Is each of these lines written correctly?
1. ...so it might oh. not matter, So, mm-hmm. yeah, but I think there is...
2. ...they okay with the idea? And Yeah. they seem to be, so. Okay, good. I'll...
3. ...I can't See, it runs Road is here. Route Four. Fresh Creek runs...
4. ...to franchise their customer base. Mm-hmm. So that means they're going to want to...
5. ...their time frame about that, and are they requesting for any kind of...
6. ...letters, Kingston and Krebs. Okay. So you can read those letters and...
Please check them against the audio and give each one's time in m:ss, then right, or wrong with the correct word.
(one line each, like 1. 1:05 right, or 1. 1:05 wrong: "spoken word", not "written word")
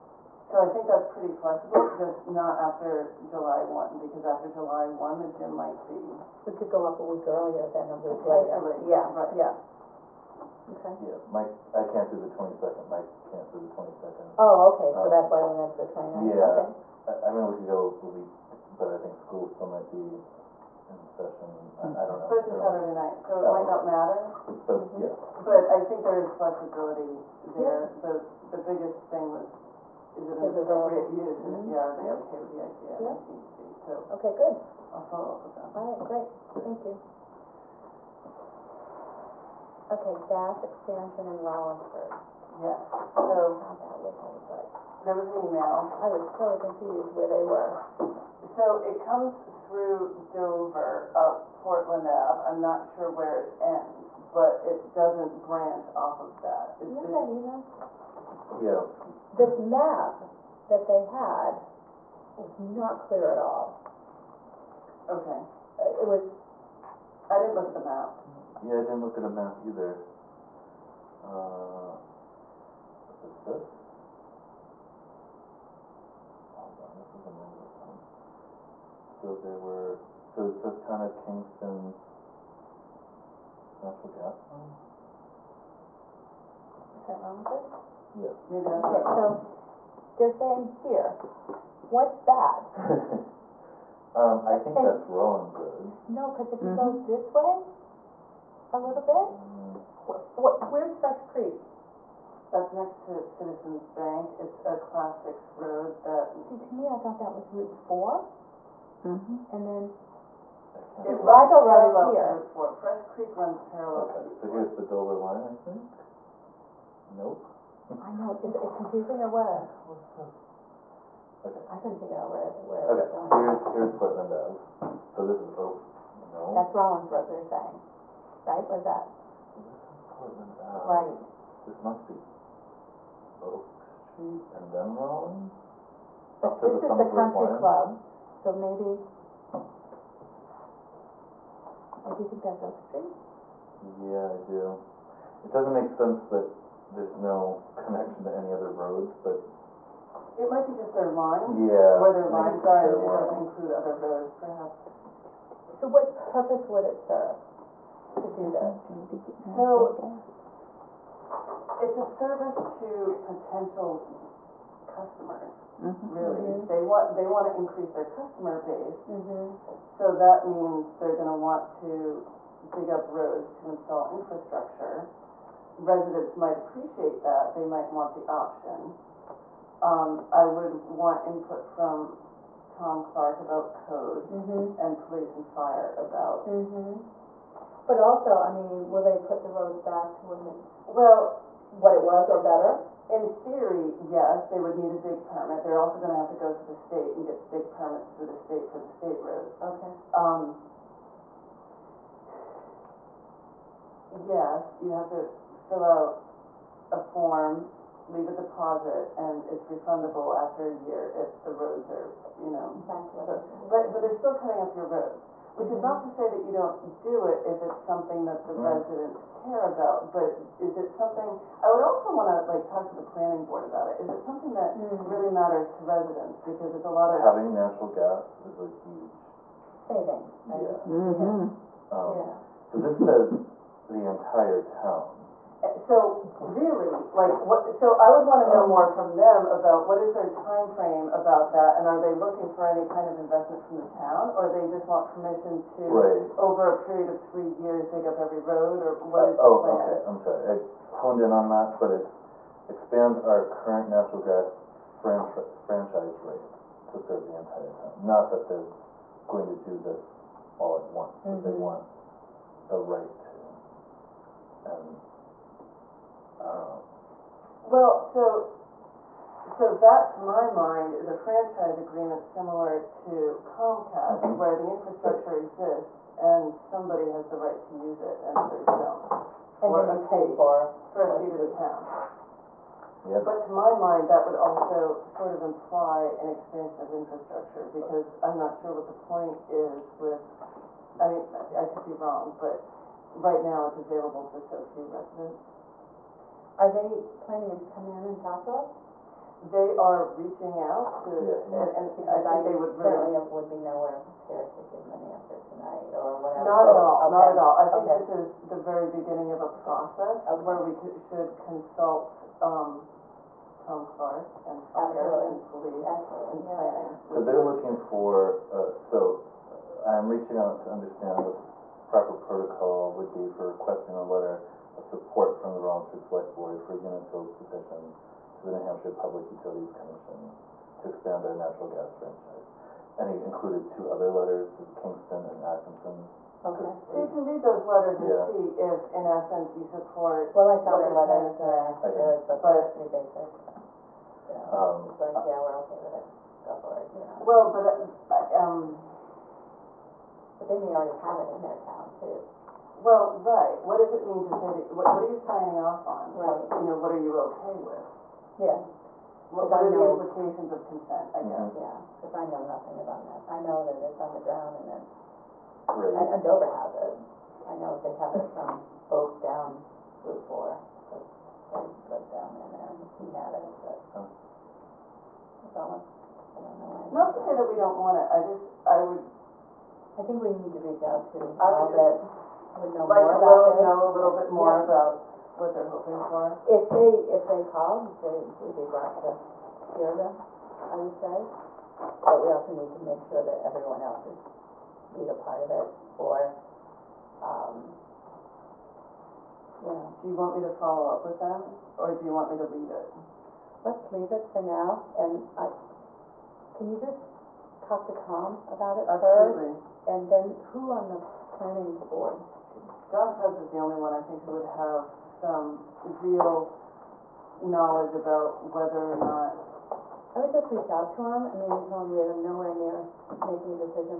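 1. 0:23 right
2. 0:31 right
3. 1:50 right
4. 2:47 wrong: "increase", not "franchise"
5. 4:00 wrong: "looking", not "requesting"
6. 5:34 wrong: "Atkinson", not "Krebs".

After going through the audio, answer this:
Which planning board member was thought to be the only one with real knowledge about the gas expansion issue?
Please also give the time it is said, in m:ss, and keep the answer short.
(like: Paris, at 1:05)
John Krebs, at 6:52.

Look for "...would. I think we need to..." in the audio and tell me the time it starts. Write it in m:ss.
6:18.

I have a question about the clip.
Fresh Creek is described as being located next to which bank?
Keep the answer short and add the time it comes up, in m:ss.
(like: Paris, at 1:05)
Citizens Bank, at 1:43.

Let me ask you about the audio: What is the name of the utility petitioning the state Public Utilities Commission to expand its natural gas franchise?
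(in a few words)
Unitil.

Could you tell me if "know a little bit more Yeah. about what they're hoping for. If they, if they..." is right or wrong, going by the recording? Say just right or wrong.
right.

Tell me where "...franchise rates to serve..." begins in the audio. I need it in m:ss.
4:15.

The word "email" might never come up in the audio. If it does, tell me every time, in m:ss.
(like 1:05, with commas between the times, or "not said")
0:45, 0:57.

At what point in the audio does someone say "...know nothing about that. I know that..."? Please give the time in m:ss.
6:02.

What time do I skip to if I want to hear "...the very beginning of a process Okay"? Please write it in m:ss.
5:08.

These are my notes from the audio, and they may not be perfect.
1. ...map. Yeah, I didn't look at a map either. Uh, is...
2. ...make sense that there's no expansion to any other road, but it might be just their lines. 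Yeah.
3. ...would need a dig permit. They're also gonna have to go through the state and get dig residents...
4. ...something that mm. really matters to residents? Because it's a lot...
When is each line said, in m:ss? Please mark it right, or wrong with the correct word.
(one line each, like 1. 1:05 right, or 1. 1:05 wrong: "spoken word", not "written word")
1. 1:07 right
2. 2:25 wrong: "connection", not "expansion"
3. 3:14 wrong: "permits", not "residents"
4. 3:44 right.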